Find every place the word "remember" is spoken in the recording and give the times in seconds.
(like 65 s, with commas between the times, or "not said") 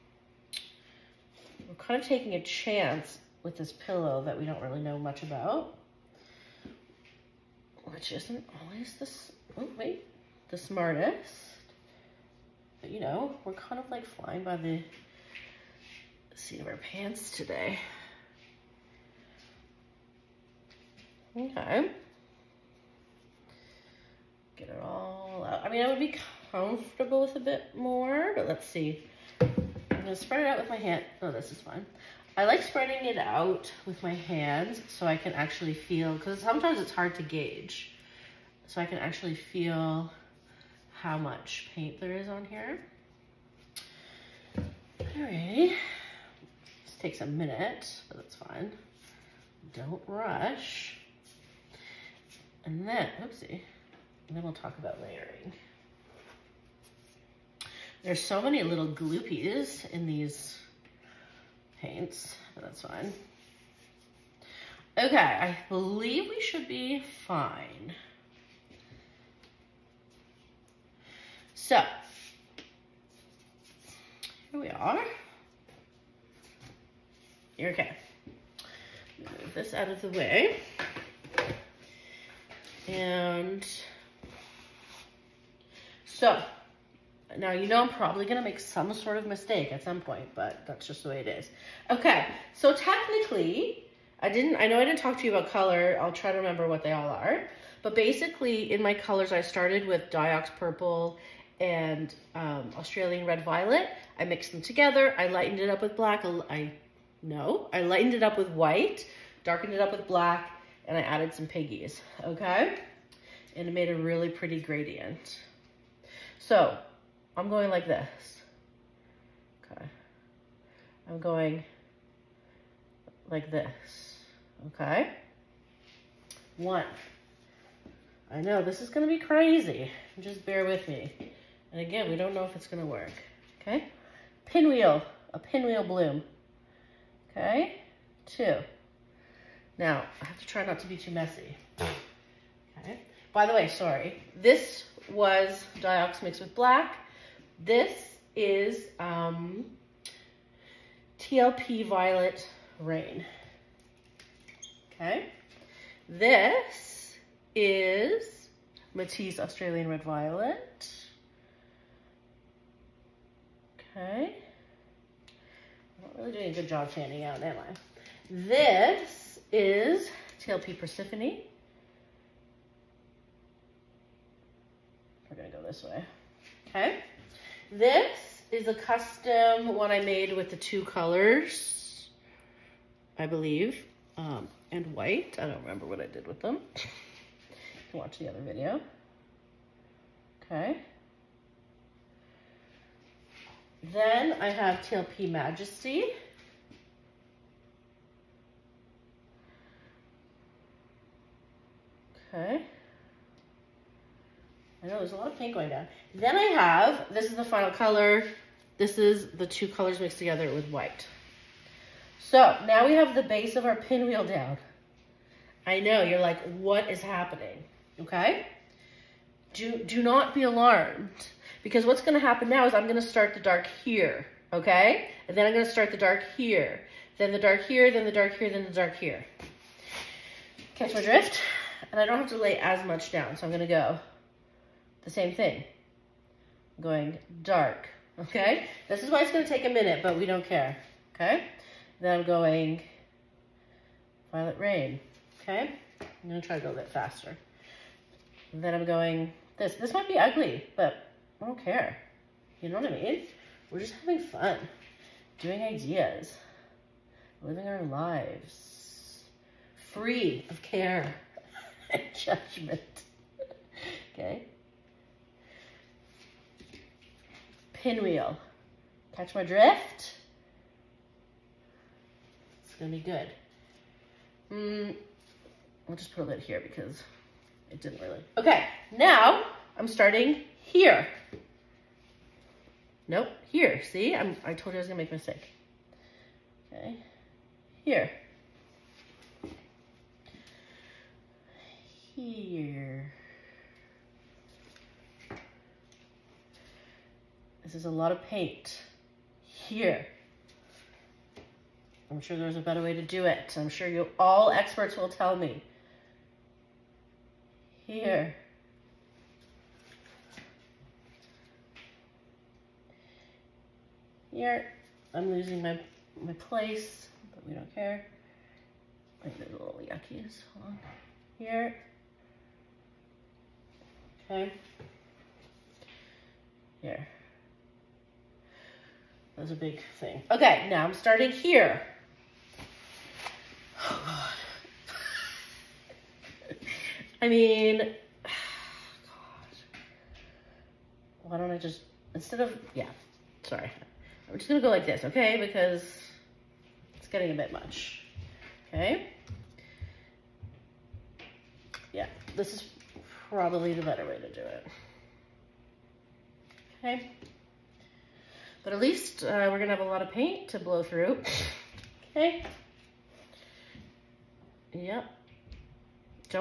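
96 s, 185 s.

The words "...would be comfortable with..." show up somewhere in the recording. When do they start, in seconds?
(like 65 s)
25 s.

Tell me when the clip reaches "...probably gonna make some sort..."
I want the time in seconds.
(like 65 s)
87 s.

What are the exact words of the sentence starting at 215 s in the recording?
I know, you're like, what is happening?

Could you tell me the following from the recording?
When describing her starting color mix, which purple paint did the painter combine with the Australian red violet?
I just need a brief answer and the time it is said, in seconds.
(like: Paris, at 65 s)
Diox Purple, at 100 s.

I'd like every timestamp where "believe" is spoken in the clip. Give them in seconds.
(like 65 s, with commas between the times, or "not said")
65 s, 183 s.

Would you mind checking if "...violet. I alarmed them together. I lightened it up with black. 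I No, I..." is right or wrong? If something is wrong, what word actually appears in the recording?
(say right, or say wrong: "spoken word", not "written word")
wrong: "mixed", not "alarmed".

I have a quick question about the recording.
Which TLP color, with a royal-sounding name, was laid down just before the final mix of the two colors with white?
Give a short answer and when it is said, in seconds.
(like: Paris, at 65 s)
Majesty, at 194 s.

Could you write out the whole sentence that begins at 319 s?
Like those little yuckies, hold on.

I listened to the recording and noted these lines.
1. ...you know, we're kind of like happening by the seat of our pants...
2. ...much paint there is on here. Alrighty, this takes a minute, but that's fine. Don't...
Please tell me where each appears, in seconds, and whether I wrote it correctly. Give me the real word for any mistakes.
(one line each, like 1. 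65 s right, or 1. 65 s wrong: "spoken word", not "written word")
1. 12 s wrong: "flying", not "happening"
2. 41 s right.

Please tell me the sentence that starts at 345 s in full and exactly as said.
Because it's getting a bit much, okay?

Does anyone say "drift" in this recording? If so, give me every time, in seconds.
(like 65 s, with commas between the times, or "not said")
231 s, 269 s.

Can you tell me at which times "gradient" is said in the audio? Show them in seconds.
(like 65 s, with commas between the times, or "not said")
114 s.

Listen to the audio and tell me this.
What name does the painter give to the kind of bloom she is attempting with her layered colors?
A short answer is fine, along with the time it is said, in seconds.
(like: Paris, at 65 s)
pinwheel bloom, at 135 s.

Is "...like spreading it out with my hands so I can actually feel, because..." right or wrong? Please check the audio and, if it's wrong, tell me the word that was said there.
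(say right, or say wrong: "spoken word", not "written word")
right.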